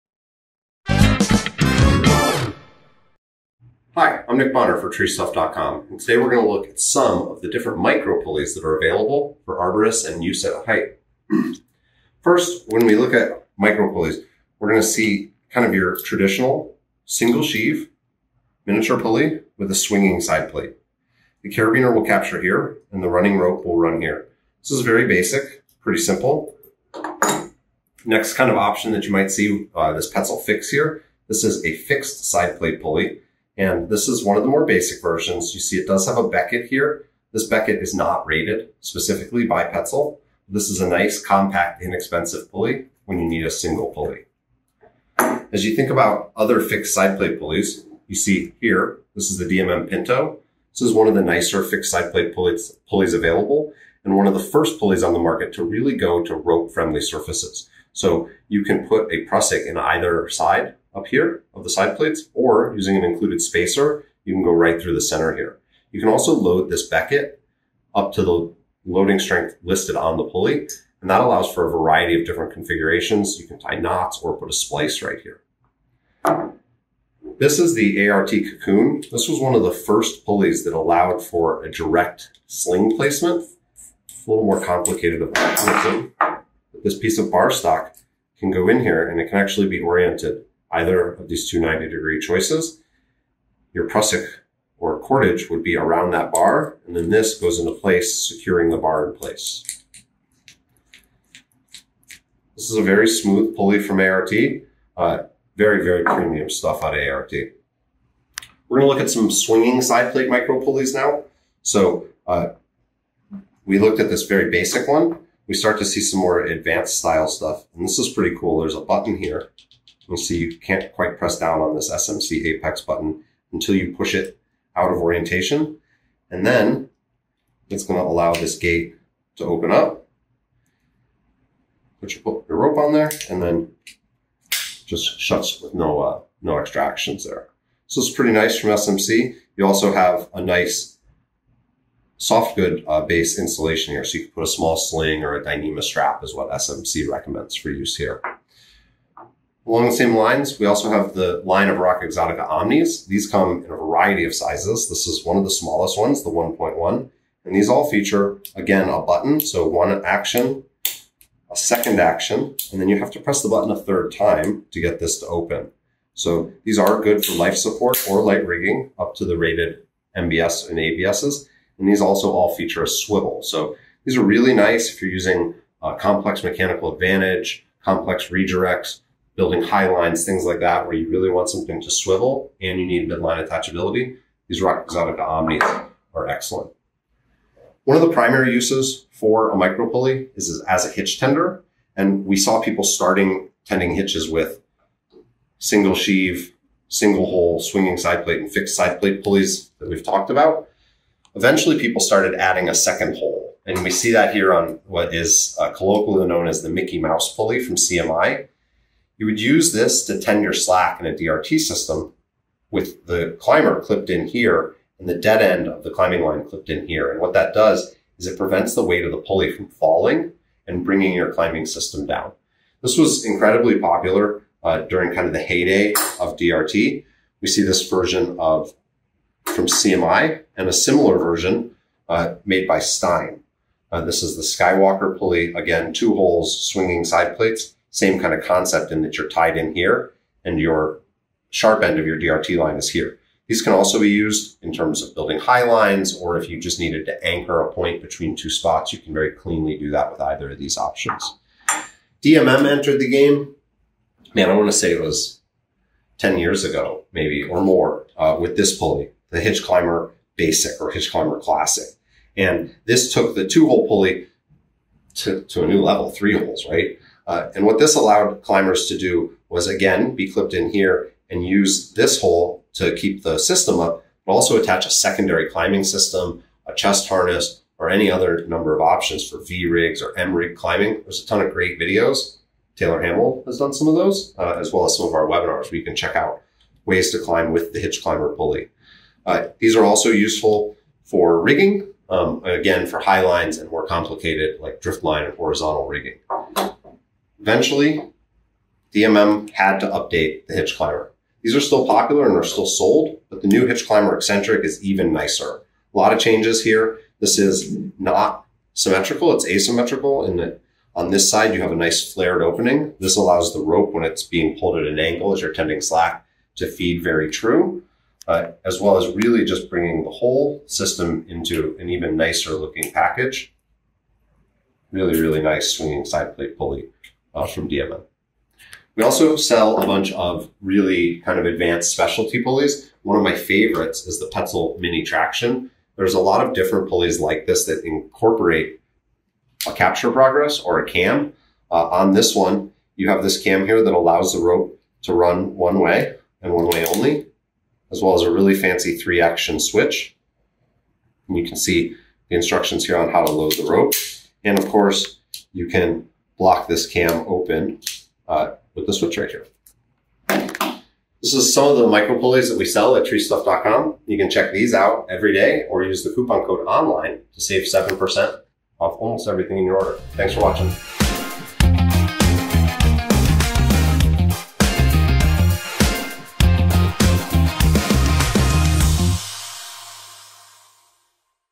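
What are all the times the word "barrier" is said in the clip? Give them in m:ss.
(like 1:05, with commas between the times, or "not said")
not said.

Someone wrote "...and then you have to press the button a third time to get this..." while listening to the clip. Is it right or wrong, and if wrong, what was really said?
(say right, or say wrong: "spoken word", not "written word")
right.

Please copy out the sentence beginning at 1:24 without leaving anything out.
It's a little more complicated of mechanism.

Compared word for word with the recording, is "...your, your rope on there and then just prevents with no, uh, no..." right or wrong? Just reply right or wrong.
wrong.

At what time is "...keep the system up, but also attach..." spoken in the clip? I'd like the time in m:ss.
4:32.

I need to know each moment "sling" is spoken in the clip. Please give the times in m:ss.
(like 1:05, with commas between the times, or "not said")
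1:22, 2:24.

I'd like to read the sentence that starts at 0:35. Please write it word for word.
You see it does have a becket here.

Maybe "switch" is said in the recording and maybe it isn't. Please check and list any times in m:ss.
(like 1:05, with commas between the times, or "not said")
5:49, 5:58.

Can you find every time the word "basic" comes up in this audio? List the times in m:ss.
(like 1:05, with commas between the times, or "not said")
0:25, 0:34, 1:54, 4:20.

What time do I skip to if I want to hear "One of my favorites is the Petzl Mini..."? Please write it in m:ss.
5:33.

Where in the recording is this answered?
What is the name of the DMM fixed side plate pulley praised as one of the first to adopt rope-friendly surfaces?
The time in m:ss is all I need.
0:49.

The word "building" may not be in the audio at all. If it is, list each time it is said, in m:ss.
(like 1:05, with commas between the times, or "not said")
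2:59, 4:05.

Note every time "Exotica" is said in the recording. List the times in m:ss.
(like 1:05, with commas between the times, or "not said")
2:32, 3:04.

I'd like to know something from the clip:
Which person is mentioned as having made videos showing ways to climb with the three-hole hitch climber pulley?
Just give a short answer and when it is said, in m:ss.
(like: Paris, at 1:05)
Taylor Hamill, at 4:42.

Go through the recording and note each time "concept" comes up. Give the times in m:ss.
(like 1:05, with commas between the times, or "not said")
3:58.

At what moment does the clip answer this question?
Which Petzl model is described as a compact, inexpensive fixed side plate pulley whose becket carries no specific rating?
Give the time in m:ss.
0:30.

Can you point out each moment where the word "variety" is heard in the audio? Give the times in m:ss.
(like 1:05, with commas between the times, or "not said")
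1:11, 2:33.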